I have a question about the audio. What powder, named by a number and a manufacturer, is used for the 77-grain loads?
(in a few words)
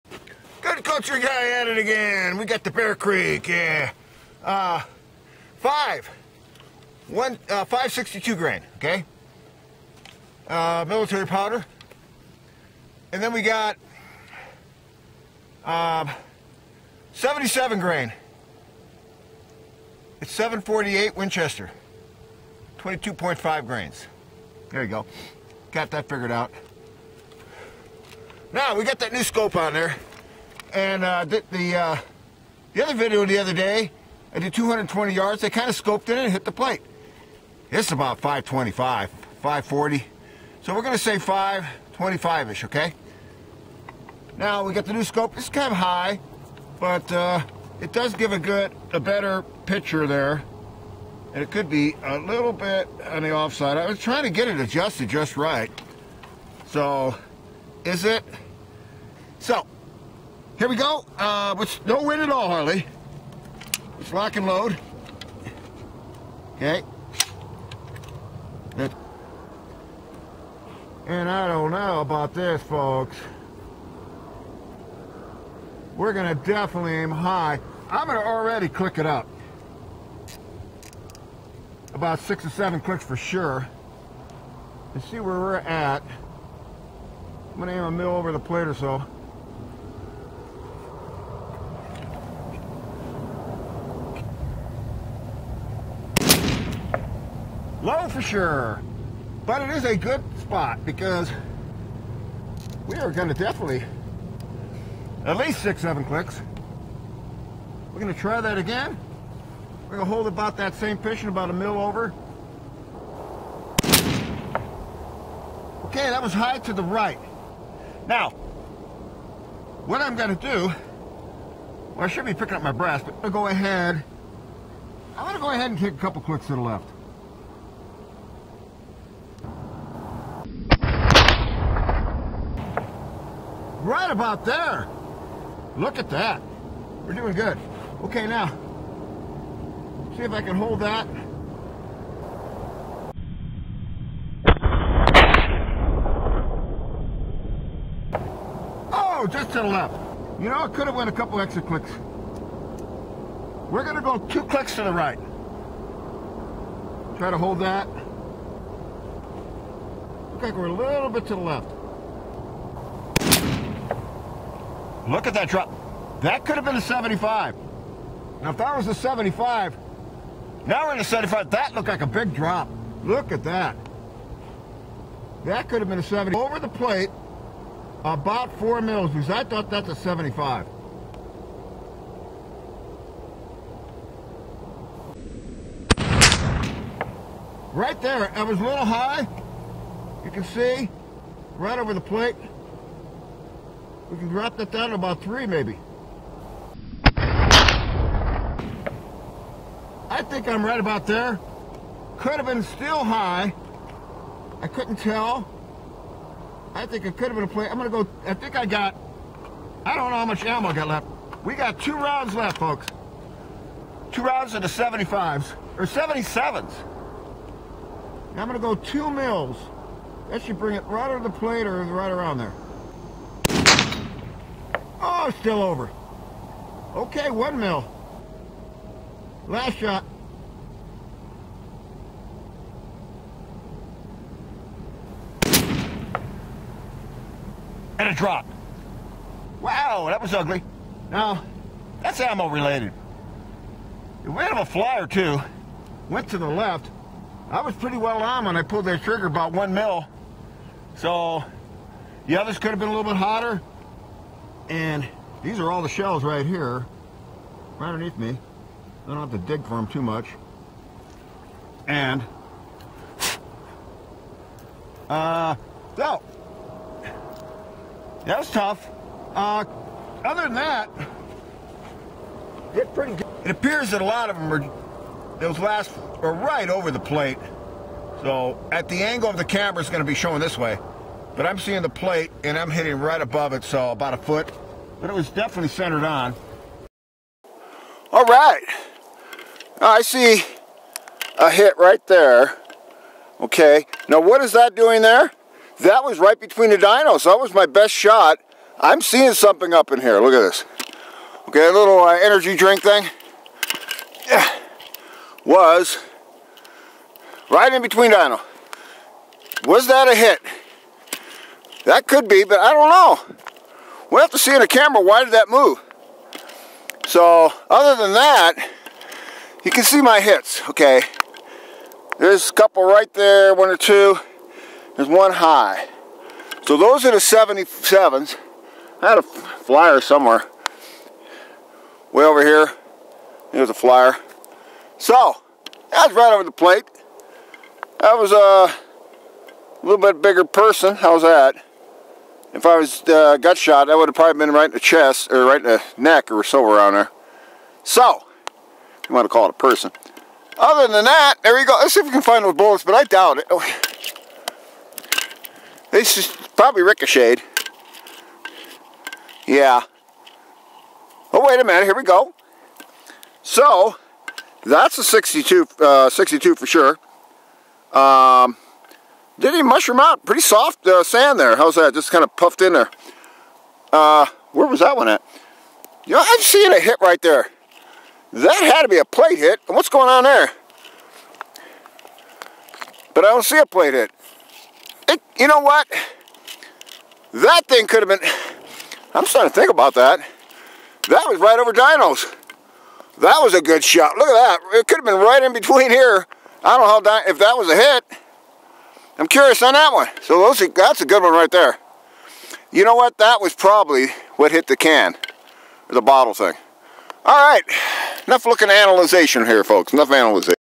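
748 Winchester.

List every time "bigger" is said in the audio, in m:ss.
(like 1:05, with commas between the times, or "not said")
5:40.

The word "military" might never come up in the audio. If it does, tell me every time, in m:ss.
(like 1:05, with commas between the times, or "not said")
0:10.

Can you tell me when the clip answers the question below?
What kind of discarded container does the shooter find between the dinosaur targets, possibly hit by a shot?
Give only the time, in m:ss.
5:02.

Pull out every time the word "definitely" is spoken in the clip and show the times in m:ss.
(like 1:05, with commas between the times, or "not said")
1:16, 1:43, 4:45.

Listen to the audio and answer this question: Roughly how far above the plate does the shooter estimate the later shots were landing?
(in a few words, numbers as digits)
about a foot.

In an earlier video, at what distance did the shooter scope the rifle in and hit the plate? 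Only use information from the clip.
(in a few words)
220 yards.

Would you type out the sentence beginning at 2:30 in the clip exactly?
You know, I could have went a couple extra clicks.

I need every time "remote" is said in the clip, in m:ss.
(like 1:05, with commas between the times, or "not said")
not said.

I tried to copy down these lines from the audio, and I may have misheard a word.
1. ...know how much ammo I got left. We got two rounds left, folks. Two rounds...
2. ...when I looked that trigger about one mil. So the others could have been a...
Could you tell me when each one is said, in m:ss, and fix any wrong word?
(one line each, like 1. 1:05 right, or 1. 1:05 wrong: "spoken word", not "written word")
1. 3:30 right
2. 4:08 wrong: "pulled", not "looked".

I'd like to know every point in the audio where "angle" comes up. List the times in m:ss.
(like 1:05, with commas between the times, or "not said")
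4:39.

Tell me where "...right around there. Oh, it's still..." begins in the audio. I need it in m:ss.
3:41.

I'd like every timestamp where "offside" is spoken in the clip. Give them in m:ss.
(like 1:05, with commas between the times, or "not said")
0:53.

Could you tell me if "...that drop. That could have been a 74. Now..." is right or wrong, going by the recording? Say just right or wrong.
wrong.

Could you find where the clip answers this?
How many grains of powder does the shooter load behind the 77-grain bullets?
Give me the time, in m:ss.
0:22.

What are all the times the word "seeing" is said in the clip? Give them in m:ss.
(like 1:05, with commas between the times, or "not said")
4:41, 4:59, 6:16.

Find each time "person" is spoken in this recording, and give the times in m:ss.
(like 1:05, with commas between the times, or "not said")
5:40, 5:49.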